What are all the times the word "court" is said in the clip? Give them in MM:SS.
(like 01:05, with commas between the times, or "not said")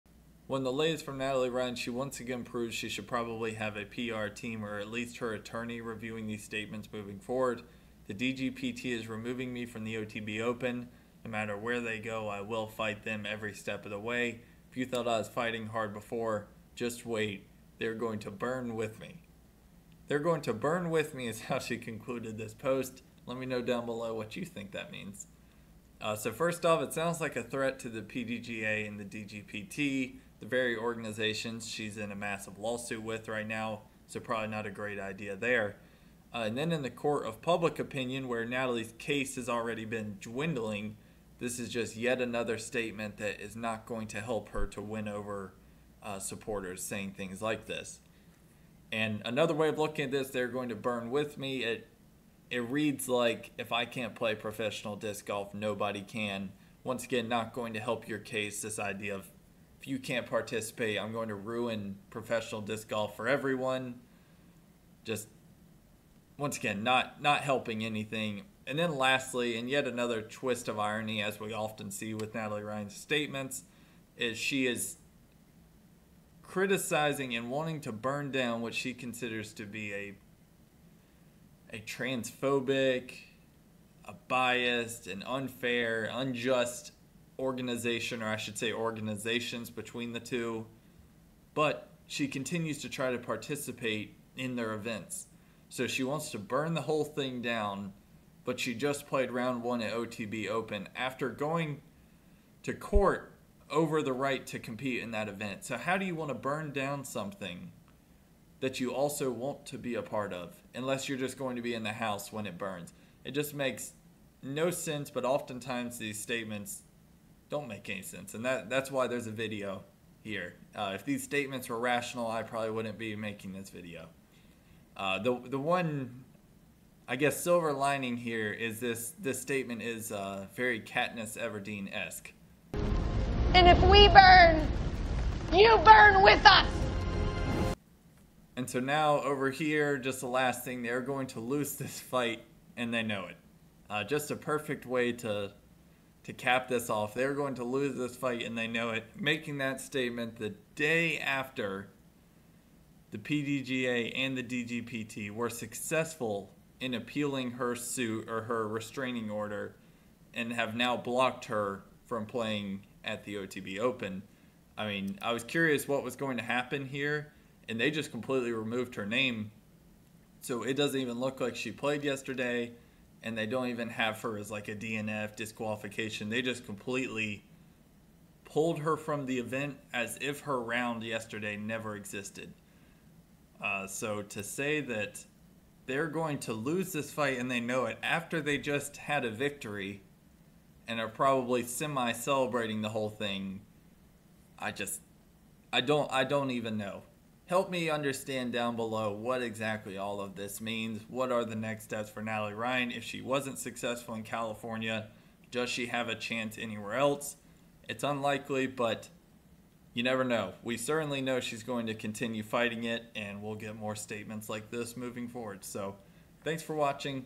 00:36, 01:42.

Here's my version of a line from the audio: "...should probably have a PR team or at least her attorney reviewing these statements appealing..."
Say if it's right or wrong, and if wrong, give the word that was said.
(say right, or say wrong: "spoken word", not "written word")
wrong: "moving", not "appealing".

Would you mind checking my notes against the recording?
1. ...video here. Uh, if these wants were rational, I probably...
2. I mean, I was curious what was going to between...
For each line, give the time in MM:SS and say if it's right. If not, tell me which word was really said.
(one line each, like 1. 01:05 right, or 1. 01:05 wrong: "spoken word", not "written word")
1. 01:59 wrong: "statements", not "wants"
2. 02:44 wrong: "happen", not "between".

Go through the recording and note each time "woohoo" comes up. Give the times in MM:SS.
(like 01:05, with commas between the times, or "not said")
not said.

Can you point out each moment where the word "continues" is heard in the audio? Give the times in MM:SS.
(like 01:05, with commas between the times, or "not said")
01:32, 03:31.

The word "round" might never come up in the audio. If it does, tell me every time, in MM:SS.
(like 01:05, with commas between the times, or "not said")
01:39, 03:00.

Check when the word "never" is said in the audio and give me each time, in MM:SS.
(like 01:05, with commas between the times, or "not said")
03:01, 03:30.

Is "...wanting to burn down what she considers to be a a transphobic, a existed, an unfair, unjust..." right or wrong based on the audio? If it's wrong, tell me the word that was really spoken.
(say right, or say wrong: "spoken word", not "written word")
wrong: "biased", not "existed".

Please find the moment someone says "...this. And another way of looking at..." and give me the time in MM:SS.
00:47.